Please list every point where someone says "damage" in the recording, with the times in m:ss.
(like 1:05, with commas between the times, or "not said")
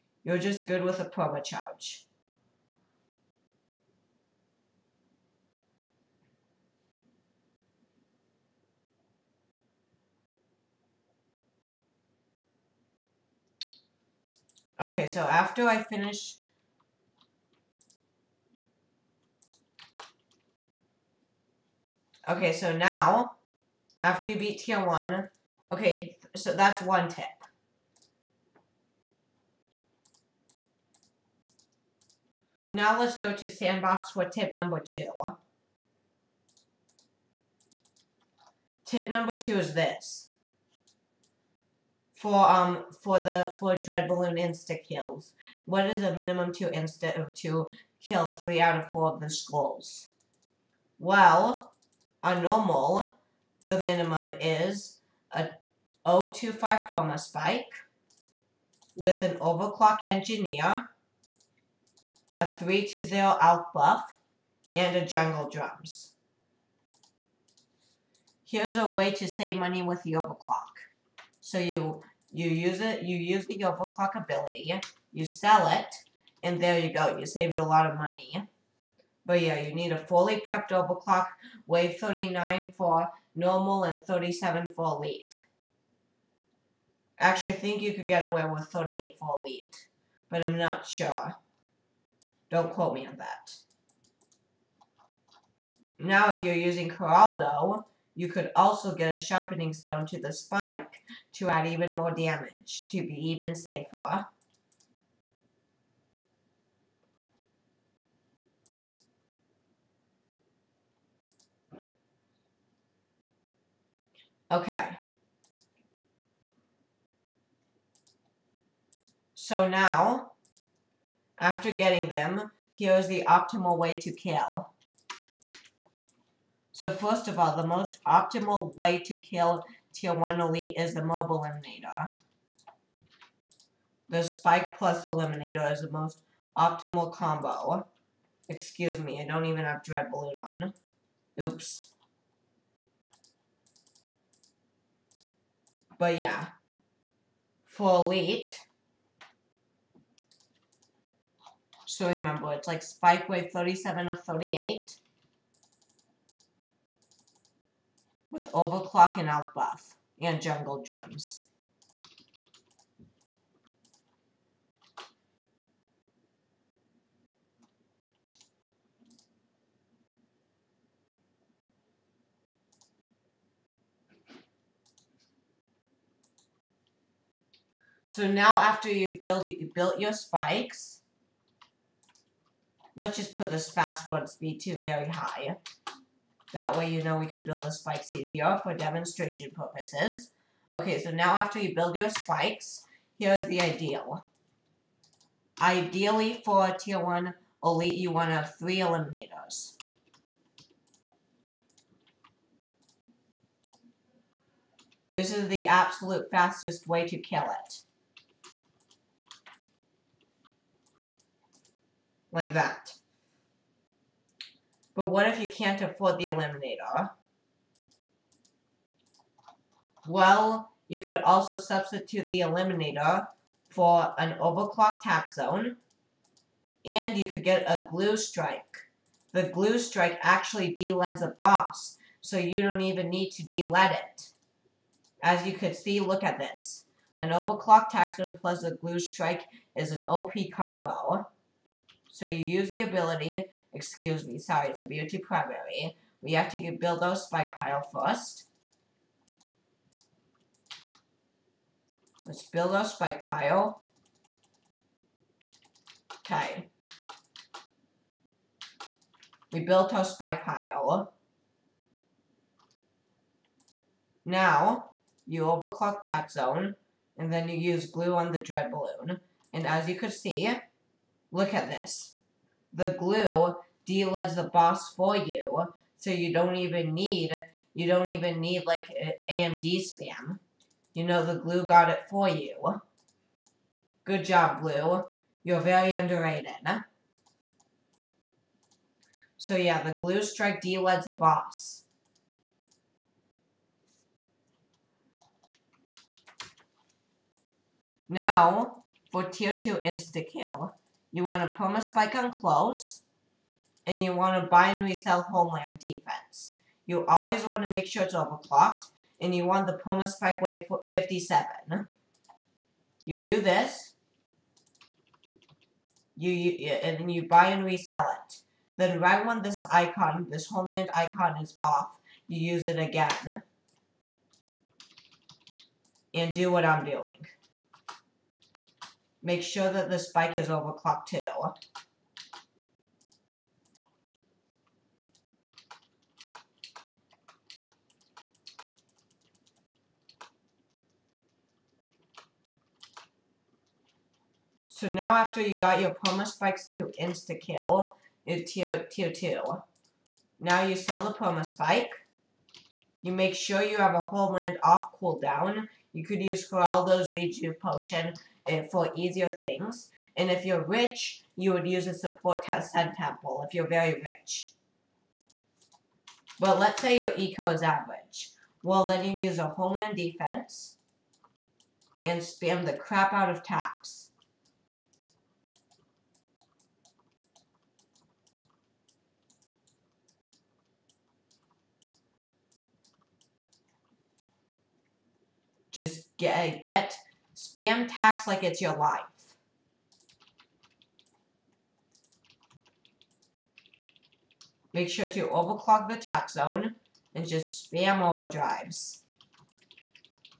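1:42.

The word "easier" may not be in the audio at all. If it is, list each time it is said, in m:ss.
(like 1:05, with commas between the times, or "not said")
3:08, 5:58.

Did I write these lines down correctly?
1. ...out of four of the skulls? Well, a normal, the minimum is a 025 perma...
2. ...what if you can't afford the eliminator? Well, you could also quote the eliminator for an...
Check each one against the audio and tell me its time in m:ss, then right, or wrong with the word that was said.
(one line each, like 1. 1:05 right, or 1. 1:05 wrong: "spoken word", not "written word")
1. 0:48 right
2. 3:35 wrong: "substitute", not "quote".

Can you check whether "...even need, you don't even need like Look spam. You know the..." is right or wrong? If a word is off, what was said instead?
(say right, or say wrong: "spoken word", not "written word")
wrong: "AMD", not "Look".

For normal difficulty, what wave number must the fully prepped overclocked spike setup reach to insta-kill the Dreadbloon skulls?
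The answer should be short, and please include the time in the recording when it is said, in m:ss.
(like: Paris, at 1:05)
39, at 1:21.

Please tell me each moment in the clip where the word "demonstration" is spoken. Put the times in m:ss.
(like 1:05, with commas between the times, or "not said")
3:08.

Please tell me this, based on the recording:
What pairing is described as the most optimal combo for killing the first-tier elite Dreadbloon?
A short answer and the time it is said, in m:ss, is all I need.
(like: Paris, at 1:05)
spike plus eliminator, at 2:14.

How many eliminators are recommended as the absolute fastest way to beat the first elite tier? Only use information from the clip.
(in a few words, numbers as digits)
3.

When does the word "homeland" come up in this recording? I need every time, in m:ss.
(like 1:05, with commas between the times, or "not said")
5:05, 5:20, 5:54, 6:09.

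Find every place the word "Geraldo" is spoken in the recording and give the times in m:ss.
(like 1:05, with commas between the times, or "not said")
1:36, 5:56.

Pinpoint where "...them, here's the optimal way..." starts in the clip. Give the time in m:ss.
2:02.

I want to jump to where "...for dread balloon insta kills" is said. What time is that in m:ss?
0:43.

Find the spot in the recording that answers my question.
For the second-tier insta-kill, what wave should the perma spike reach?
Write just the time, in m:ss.
5:09.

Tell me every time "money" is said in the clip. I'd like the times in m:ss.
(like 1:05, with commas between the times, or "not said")
1:09, 1:17.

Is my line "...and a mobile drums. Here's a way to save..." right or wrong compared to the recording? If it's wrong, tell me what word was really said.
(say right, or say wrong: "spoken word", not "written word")
wrong: "jungle", not "mobile".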